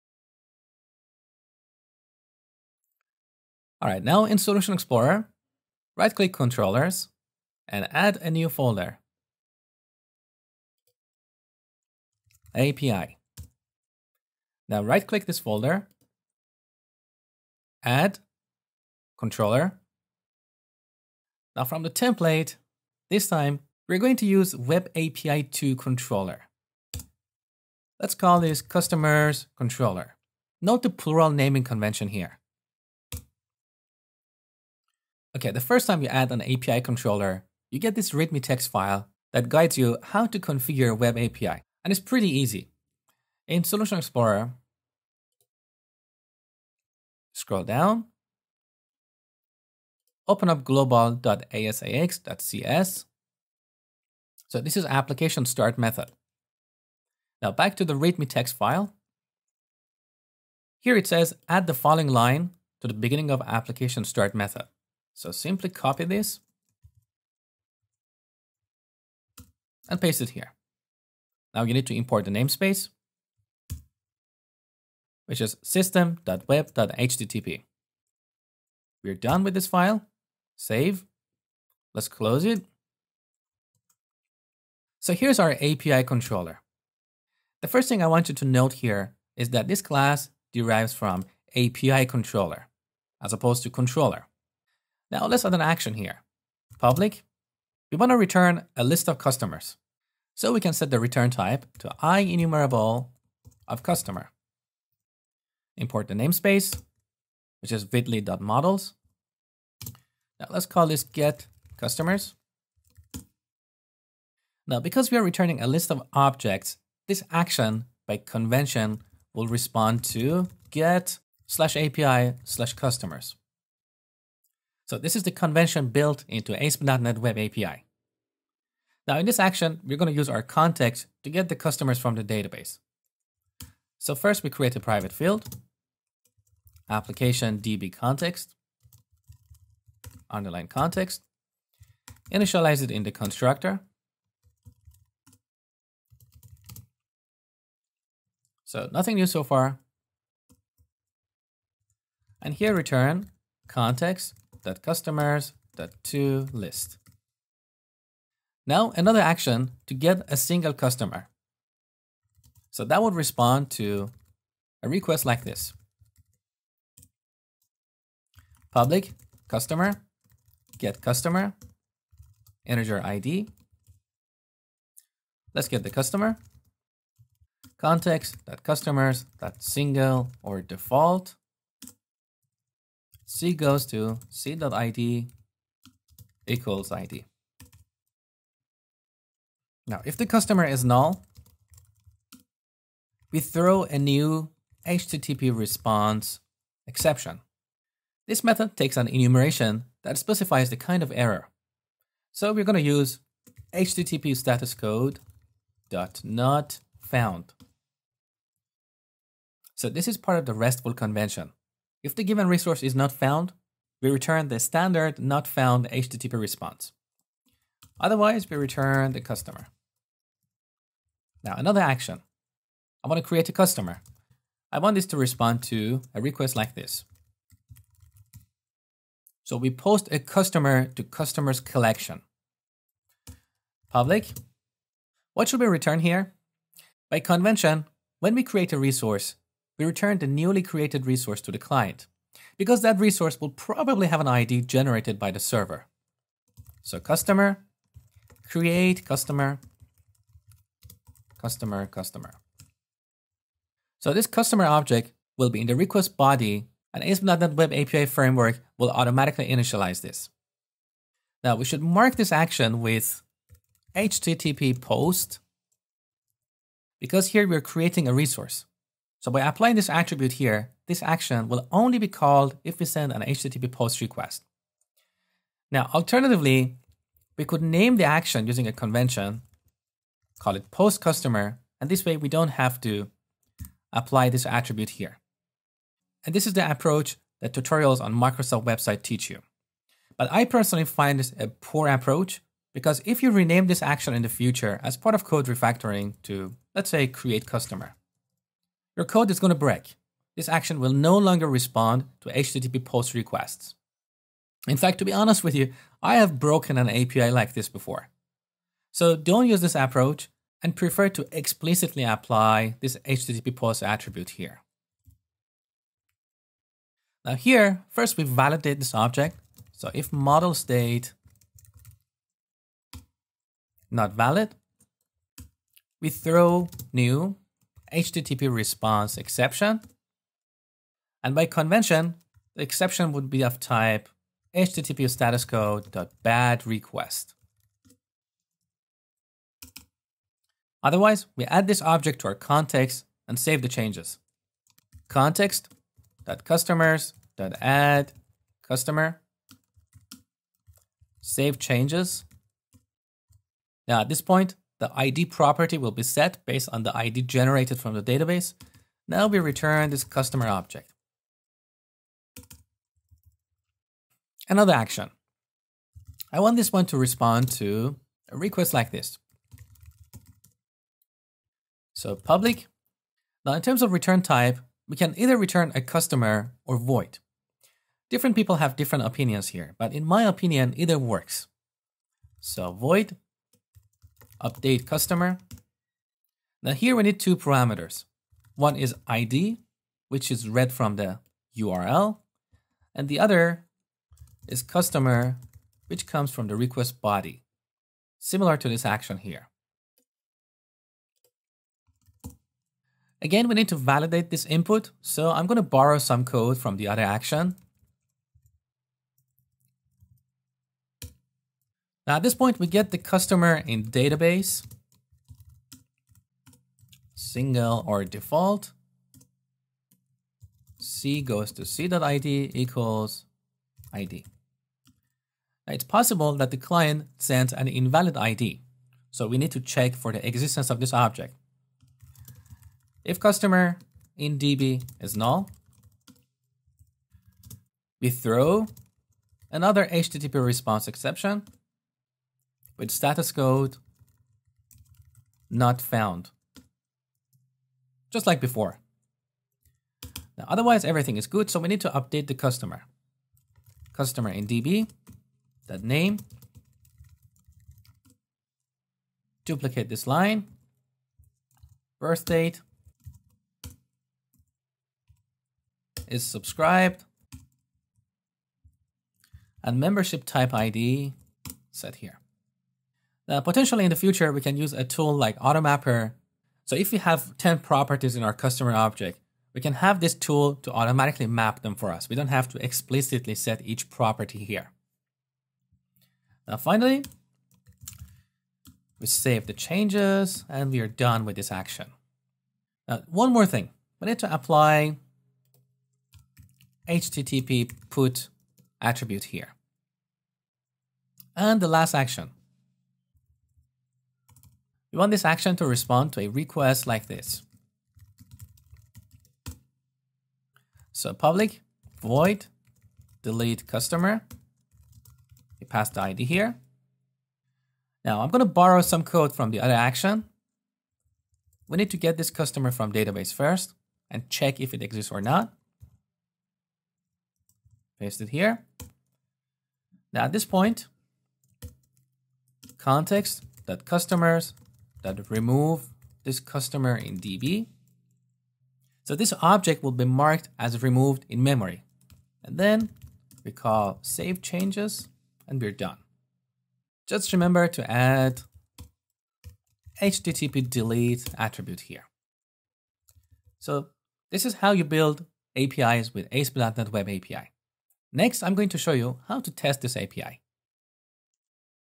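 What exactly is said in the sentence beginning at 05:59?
Now we return this customer object.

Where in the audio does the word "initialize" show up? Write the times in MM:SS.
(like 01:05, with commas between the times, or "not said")
02:22, 04:19.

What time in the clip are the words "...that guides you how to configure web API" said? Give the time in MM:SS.
00:39.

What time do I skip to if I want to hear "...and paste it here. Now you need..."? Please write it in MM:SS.
01:09.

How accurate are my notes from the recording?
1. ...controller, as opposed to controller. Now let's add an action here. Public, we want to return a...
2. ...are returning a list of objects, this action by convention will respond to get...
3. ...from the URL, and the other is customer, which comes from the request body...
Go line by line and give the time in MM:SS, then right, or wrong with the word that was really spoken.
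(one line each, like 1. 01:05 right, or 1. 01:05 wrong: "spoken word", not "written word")
1. 01:32 right
2. 01:55 right
3. 06:30 right.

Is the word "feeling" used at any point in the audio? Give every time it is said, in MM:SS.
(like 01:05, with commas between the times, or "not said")
not said.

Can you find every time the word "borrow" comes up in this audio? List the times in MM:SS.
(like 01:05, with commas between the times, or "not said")
06:45, 08:38.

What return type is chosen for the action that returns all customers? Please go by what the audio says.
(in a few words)
IEnumerable of customer.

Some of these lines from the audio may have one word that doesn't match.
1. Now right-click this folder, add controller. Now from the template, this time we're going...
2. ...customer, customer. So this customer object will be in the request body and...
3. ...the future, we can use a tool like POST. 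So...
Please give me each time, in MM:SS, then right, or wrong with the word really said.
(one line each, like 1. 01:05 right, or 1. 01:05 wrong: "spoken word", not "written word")
1. 00:14 right
2. 04:11 right
3. 07:53 wrong: "Automapper", not "POST".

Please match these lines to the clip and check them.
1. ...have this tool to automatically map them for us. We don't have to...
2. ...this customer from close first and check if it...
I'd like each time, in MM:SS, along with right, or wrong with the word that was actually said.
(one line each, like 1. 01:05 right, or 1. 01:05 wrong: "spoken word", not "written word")
1. 07:59 right
2. 08:42 wrong: "database", not "close".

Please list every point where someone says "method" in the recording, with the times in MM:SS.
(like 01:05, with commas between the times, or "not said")
00:55, 01:04, 03:18.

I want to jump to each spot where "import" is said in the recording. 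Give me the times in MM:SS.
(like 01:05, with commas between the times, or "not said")
01:11, 01:45.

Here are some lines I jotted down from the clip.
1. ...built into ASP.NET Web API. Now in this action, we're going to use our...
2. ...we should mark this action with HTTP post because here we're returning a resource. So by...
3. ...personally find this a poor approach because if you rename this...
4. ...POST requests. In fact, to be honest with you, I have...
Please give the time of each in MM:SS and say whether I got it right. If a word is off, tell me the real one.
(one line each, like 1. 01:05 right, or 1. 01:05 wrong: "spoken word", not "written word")
1. 02:05 right
2. 04:21 wrong: "creating", not "returning"
3. 04:50 right
4. 05:02 right.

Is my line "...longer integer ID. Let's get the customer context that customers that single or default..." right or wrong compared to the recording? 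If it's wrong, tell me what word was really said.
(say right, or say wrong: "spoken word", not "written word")
wrong: "customer", not "longer".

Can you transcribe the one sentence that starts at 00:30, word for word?
Note the plural naming convention here.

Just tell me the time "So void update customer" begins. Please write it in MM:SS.
06:22.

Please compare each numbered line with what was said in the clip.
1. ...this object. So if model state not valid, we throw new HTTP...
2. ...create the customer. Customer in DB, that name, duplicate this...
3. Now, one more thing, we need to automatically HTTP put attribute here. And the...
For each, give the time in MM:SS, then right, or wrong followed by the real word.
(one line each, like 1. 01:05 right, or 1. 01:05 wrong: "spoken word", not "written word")
1. 05:18 right
2. 07:31 wrong: "update", not "create"
3. 08:12 wrong: "apply", not "automatically".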